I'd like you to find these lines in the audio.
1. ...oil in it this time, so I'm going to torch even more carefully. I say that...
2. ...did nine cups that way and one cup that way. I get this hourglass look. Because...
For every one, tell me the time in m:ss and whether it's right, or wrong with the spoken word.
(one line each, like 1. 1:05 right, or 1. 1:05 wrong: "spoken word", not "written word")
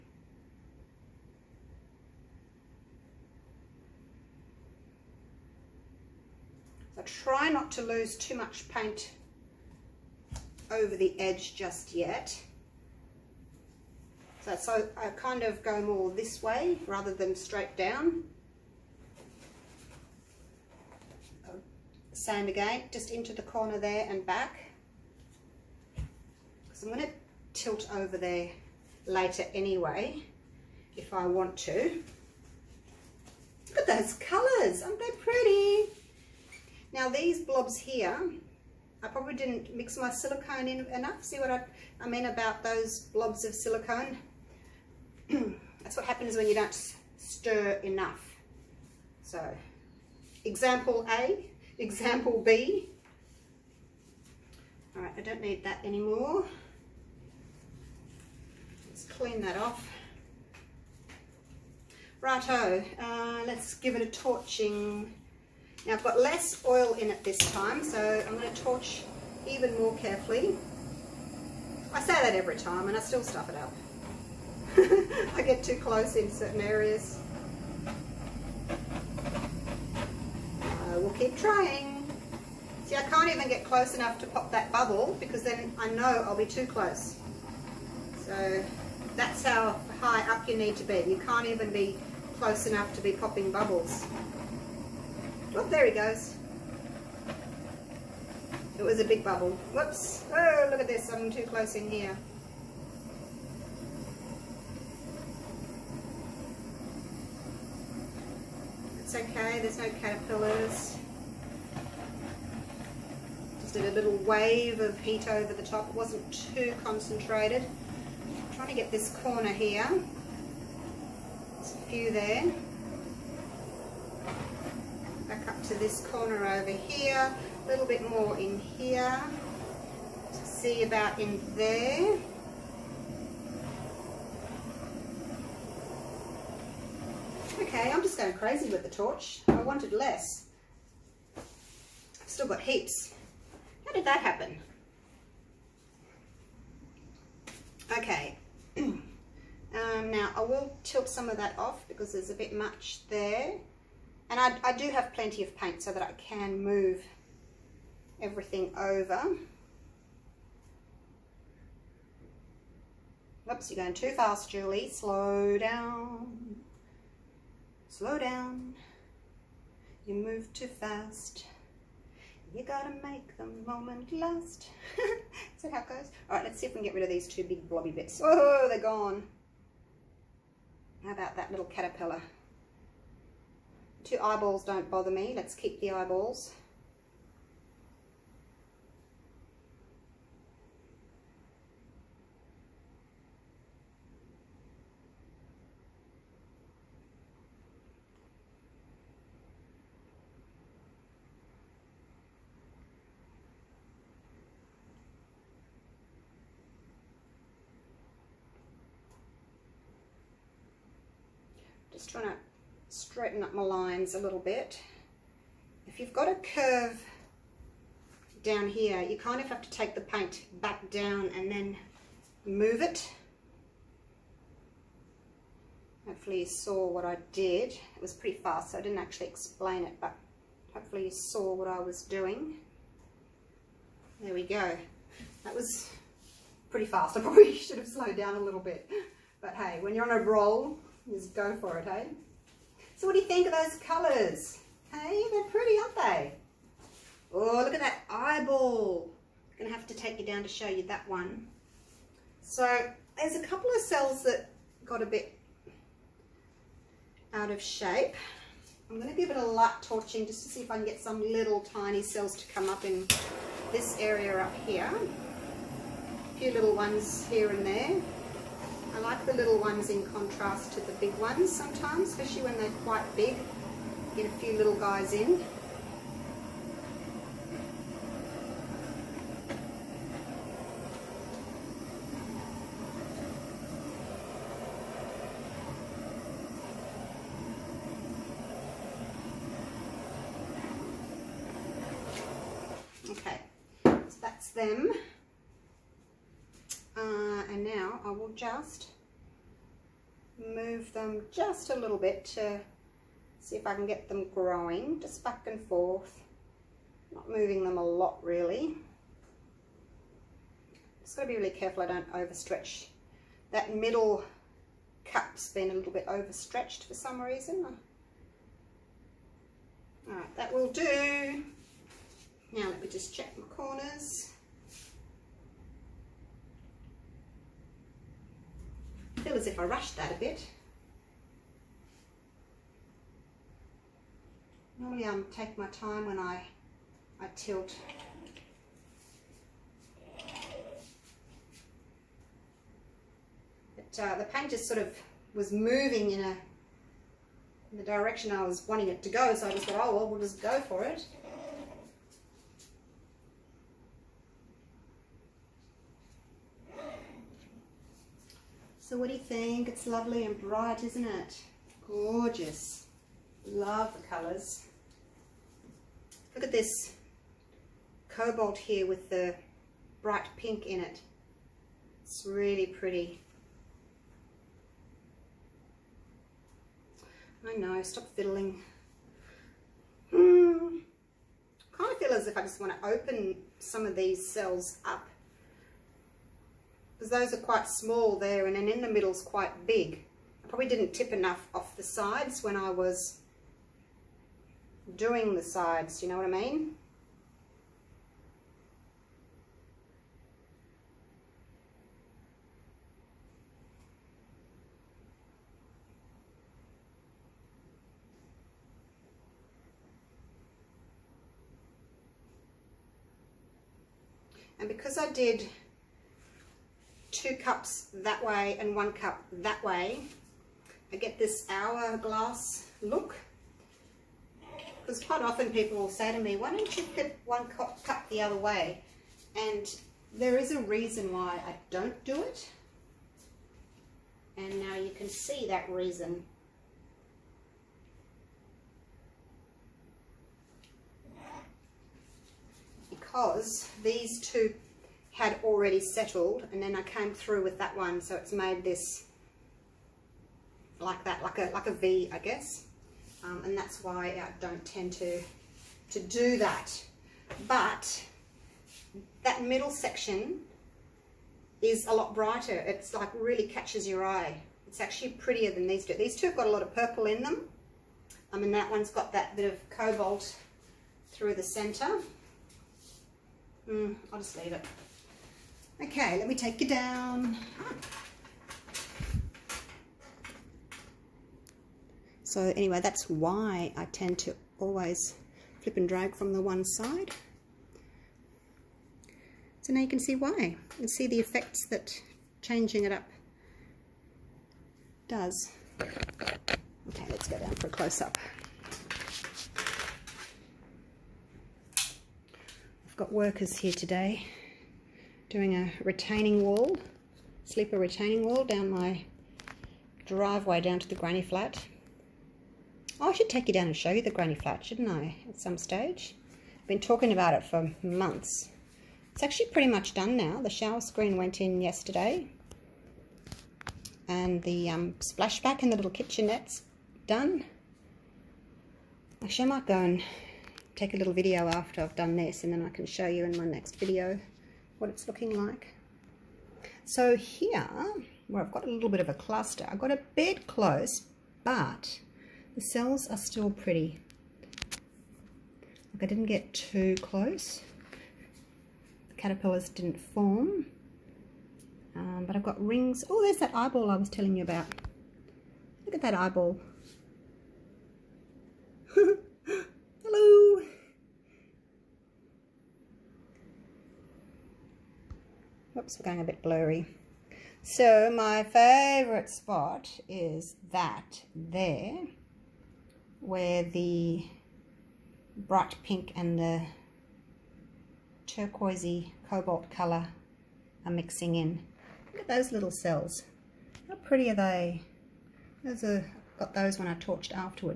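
1. 1:06 right
2. 6:55 wrong: "two", not "nine".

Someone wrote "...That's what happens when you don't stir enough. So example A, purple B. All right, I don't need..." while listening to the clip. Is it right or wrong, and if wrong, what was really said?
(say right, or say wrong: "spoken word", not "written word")
wrong: "example", not "purple".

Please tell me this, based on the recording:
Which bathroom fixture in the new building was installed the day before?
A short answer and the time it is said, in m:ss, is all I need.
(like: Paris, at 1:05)
shower screen, at 8:40.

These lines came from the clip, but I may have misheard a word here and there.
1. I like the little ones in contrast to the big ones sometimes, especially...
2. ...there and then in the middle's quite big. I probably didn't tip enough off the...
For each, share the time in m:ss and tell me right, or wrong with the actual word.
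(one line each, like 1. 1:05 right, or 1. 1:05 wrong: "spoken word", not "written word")
1. 4:28 right
2. 6:28 right.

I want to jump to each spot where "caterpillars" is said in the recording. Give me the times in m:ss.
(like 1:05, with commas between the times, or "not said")
1:49, 3:01, 9:09.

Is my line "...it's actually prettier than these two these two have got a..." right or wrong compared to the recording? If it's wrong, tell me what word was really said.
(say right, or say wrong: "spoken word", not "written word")
right.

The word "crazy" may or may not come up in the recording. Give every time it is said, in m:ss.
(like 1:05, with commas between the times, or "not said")
2:18.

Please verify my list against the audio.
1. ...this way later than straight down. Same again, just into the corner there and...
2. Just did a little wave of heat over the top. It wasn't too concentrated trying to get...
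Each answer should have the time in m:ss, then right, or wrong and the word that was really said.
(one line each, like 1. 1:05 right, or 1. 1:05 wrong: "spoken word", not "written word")
1. 0:16 wrong: "rather", not "later"
2. 1:53 right.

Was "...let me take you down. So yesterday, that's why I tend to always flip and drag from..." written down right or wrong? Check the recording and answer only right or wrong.
wrong.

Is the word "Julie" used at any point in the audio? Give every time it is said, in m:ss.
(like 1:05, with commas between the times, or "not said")
2:44.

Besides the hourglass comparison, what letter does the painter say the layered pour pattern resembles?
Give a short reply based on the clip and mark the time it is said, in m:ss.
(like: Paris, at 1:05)
V, at 7:31.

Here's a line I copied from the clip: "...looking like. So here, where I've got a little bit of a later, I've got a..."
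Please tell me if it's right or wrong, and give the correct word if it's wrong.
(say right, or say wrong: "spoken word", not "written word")
wrong: "cluster", not "later".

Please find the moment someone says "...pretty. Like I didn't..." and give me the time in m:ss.
9:03.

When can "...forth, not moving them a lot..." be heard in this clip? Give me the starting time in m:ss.
5:05.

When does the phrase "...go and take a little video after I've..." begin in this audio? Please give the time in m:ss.
8:49.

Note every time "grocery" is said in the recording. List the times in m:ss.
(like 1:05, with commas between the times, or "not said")
not said.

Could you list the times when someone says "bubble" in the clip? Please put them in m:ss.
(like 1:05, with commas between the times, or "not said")
1:24, 1:33, 1:39.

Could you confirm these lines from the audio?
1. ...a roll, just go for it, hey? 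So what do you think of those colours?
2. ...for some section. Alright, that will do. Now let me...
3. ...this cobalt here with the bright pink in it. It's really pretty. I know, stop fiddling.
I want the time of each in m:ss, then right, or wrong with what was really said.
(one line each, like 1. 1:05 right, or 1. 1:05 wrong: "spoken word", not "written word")
1. 4:00 right
2. 5:16 wrong: "reason", not "section"
3. 6:06 right.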